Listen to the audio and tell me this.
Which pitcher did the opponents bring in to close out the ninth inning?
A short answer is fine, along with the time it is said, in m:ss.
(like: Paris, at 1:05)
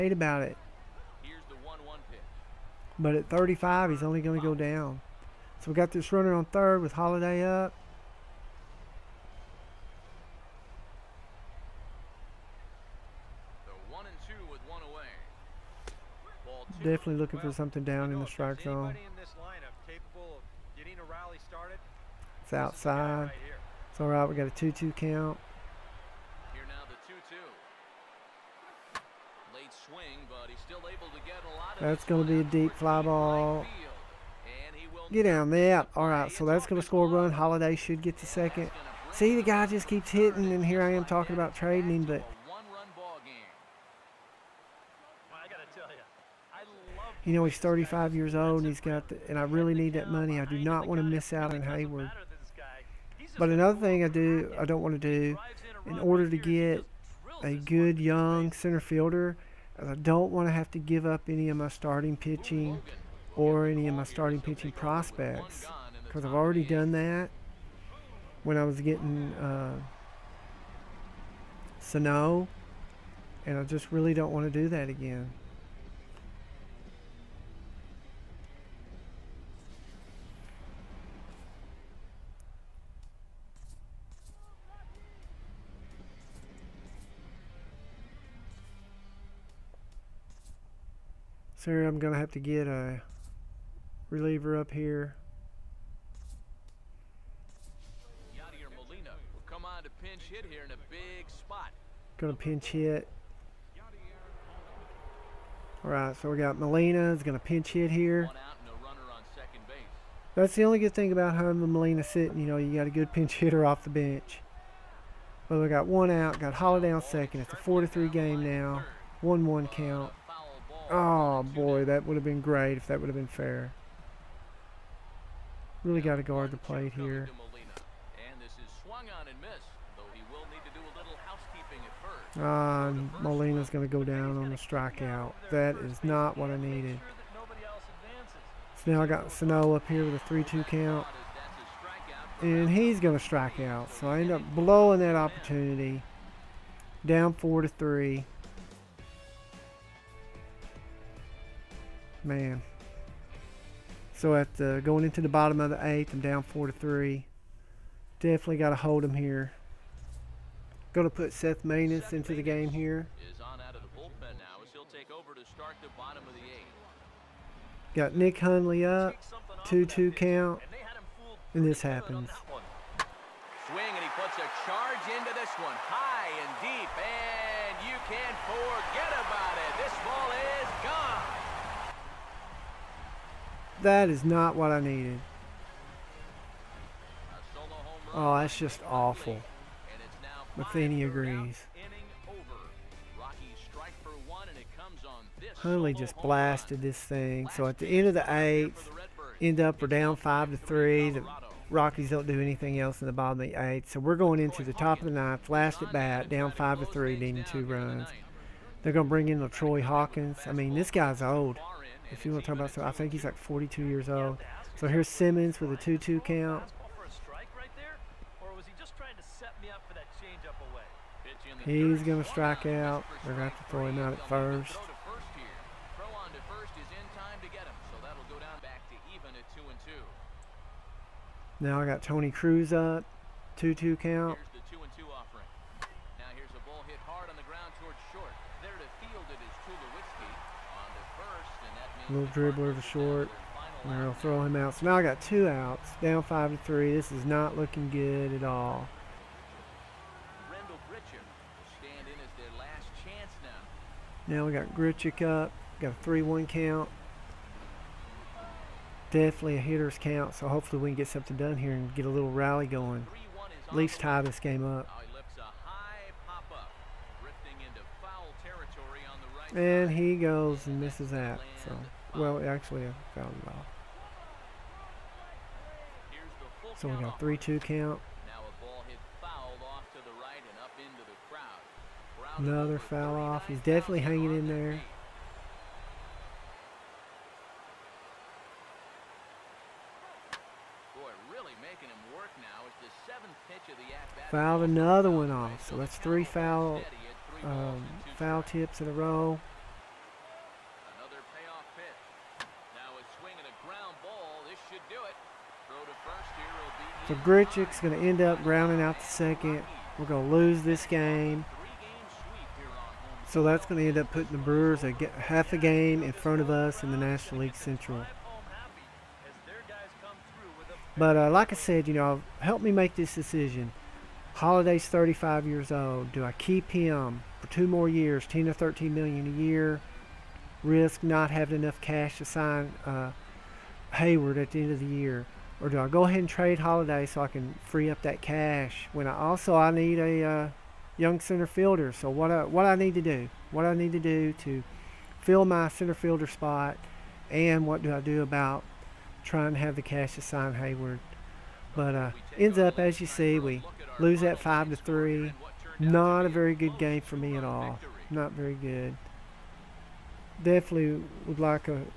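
Troy Hawkins, at 3:29.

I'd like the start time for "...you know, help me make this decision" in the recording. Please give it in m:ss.
5:21.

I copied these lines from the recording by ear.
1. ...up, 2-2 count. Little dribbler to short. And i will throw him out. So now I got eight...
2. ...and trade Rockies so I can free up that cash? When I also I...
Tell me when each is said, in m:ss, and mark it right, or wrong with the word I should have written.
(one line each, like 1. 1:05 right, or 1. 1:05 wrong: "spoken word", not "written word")
1. 3:52 wrong: "two", not "eight"
2. 5:36 wrong: "Holliday", not "Rockies".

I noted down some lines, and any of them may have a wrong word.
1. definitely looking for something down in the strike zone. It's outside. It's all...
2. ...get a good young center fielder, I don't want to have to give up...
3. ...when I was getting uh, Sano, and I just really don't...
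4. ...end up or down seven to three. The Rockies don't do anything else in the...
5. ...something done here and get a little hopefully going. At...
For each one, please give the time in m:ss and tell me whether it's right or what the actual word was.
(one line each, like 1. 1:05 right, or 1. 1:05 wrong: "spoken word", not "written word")
1. 0:16 right
2. 0:56 right
3. 1:08 right
4. 3:19 wrong: "five", not "seven"
5. 4:21 wrong: "rally", not "hopefully".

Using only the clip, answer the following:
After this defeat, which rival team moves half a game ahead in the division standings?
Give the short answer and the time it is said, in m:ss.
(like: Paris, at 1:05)
Brewers, at 5:14.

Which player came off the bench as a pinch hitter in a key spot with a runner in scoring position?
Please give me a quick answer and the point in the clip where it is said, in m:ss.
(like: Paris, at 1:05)
Yadier Molina, at 1:38.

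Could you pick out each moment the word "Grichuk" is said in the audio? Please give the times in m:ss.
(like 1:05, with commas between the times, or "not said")
4:14, 5:07.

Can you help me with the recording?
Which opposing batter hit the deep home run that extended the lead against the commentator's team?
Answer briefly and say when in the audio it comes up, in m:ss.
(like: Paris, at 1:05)
Nick Hundley, at 2:48.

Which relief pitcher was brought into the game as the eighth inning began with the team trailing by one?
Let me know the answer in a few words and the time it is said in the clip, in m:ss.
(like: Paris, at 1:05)
Seth Maness, at 2:41.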